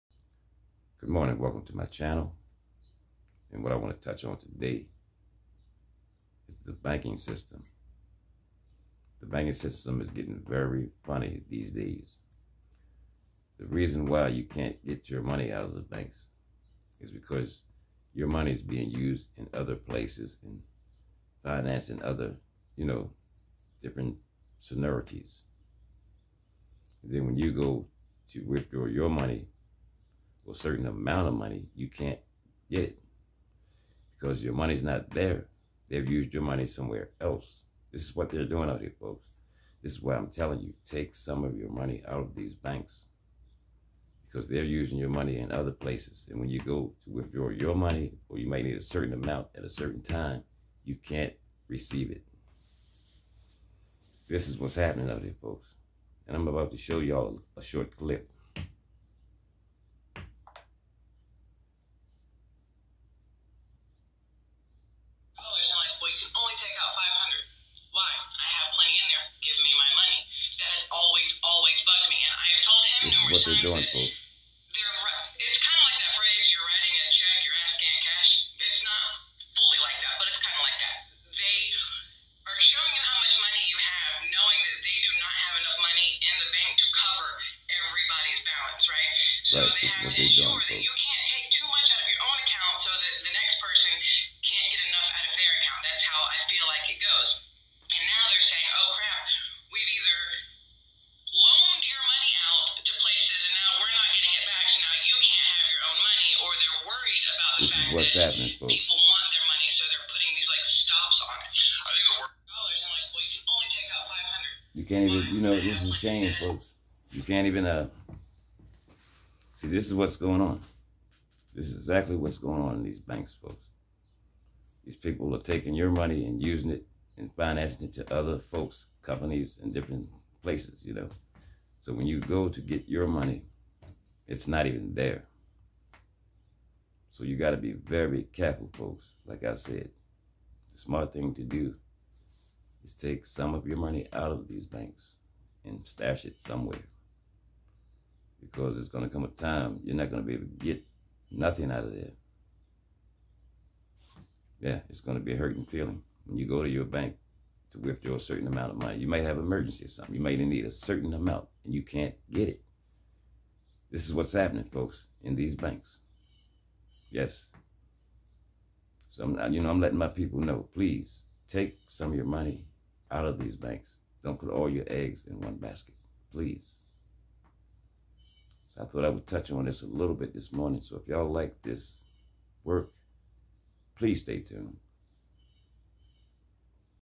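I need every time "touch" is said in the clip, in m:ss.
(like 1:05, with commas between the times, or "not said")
0:04, 2:59.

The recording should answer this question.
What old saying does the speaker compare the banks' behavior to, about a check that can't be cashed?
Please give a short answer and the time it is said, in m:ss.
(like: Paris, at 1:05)
Writing a check your ass can't cash, at 1:16.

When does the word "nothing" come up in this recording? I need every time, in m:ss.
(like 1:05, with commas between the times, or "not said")
2:31.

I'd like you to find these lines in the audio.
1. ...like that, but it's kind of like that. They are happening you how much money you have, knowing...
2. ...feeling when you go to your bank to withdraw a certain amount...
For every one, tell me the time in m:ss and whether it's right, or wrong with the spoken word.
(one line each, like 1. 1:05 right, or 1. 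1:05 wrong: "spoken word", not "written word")
1. 1:19 wrong: "showing", not "happening"
2. 2:35 right.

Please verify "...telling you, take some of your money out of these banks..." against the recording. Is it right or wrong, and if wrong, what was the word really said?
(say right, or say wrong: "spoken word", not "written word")
right.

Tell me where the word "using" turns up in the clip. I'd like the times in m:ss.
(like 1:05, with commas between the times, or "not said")
0:44, 2:06.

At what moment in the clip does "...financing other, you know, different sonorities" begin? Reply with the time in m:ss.
0:21.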